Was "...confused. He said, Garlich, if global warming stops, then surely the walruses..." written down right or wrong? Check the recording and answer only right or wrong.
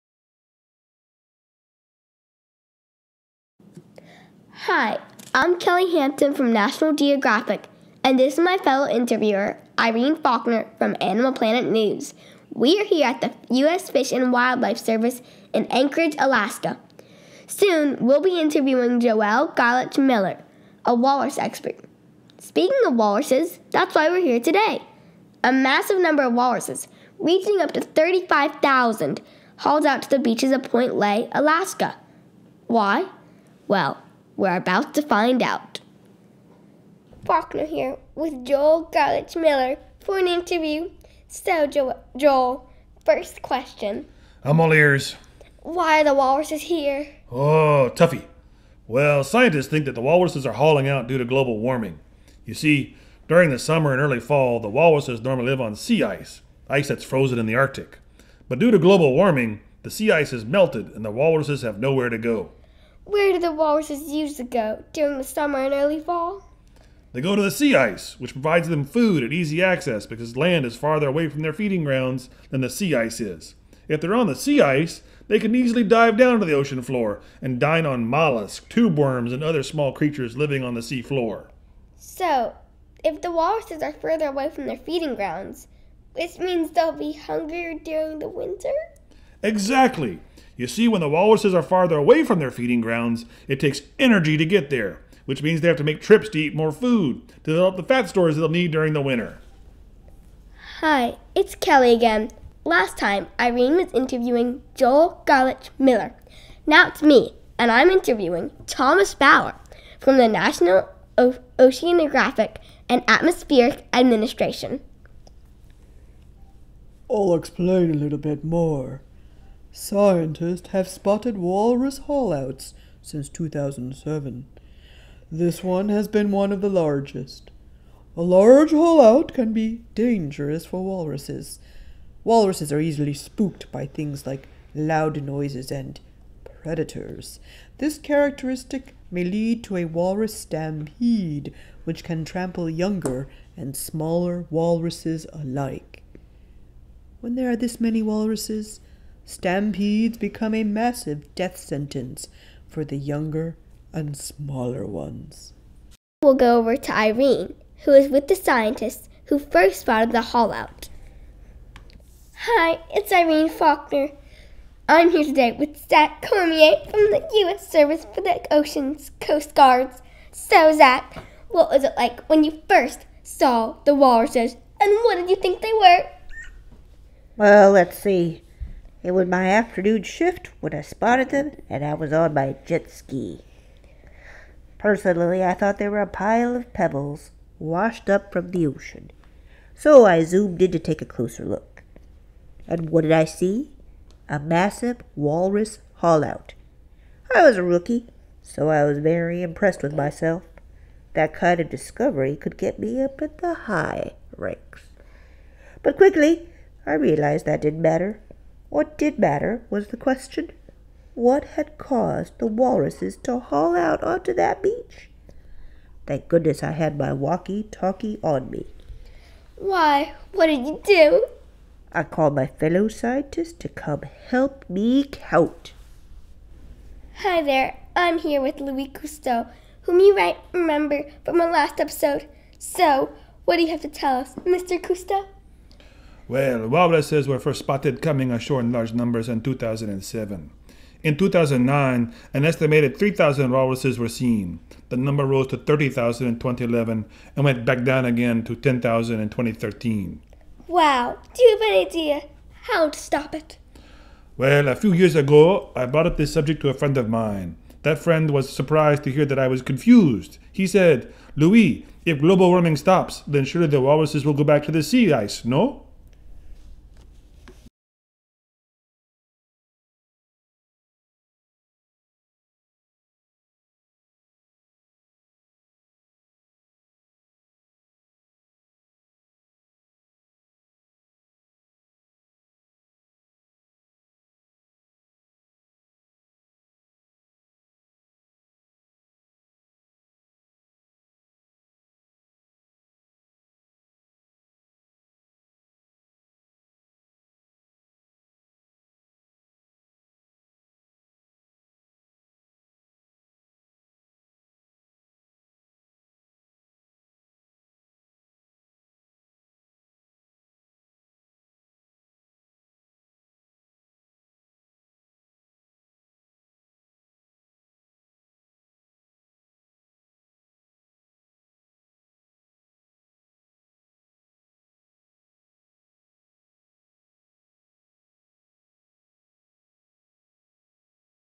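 wrong.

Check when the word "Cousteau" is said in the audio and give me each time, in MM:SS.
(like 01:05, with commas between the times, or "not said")
03:48, 03:54.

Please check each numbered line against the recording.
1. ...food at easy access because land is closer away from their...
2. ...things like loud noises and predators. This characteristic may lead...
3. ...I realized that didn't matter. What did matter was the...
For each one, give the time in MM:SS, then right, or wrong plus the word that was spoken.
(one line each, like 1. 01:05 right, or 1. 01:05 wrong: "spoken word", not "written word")
1. 01:08 wrong: "farther", not "closer"
2. 02:13 right
3. 03:26 right.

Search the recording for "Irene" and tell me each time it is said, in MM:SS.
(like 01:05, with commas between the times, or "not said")
00:09, 01:43, 02:36, 02:43.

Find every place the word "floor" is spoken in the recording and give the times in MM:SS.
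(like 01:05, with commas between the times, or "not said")
01:16, 01:21.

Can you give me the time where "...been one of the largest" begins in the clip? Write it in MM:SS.
02:06.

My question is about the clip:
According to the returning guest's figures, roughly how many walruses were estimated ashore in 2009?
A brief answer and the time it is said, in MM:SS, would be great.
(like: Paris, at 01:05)
3,000, at 04:02.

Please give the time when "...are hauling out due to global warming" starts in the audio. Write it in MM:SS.
00:50.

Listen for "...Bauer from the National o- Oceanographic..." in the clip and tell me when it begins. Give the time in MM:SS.
01:49.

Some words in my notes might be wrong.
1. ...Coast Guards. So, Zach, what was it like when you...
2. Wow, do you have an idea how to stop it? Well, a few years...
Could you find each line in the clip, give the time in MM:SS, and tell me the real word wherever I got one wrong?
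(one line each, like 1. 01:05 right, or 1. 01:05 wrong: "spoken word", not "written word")
1. 02:49 right
2. 04:10 right.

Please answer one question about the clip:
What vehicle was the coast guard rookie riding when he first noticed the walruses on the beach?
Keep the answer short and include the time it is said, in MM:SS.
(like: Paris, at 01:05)
jet ski, at 03:02.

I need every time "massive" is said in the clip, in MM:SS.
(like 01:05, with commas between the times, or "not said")
00:25, 02:30, 03:14.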